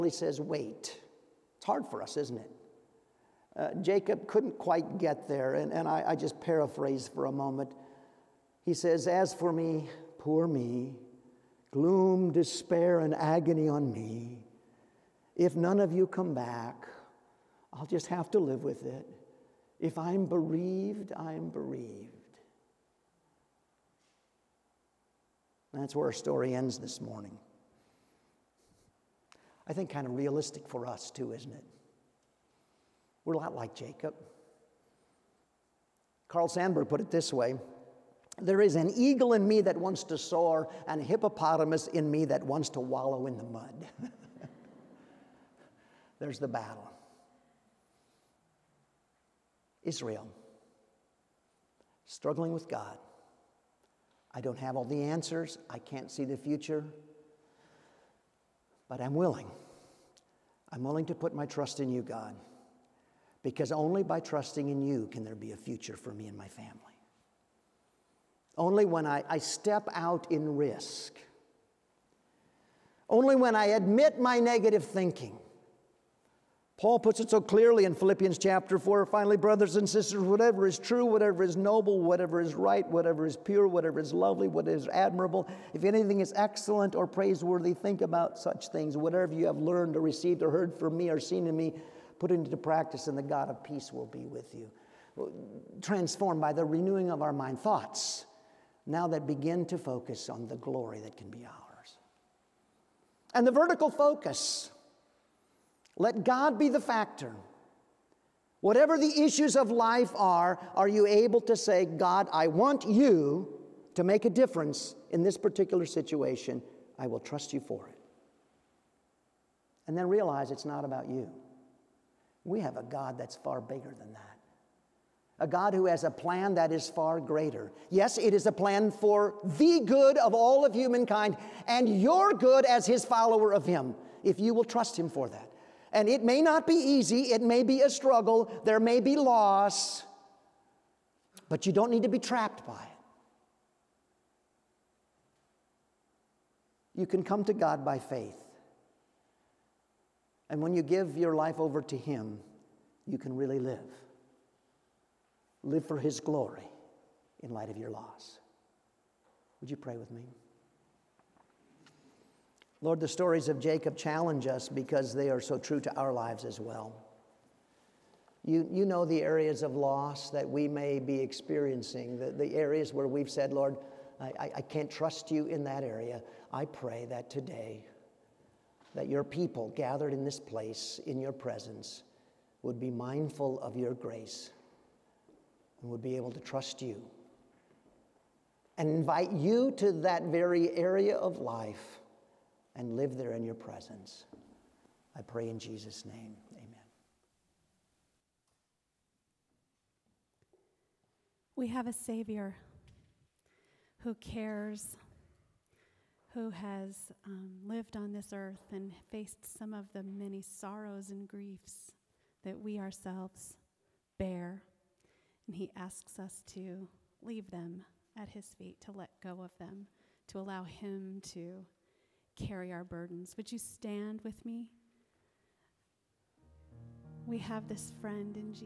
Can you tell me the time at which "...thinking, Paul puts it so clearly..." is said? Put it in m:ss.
1:14.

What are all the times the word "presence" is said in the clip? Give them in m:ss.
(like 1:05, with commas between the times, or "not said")
3:01, 3:13.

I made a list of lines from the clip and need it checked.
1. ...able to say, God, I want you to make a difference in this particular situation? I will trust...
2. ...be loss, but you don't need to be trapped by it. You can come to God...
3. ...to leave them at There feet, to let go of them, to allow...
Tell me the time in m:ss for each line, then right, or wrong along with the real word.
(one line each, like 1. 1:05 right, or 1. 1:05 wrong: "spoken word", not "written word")
1. 1:51 right
2. 2:18 right
3. 3:36 wrong: "His", not "There".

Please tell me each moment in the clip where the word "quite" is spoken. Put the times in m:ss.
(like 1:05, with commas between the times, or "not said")
0:04.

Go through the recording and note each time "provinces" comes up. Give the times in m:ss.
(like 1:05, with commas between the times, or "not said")
not said.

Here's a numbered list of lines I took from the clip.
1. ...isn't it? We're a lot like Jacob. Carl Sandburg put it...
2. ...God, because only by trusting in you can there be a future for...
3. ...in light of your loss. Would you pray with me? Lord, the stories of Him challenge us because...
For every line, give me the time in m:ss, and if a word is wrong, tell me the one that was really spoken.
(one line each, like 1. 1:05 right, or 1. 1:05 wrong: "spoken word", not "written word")
1. 0:31 right
2. 1:02 right
3. 2:37 wrong: "Jacob", not "Him".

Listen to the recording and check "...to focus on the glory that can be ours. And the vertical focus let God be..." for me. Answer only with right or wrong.
right.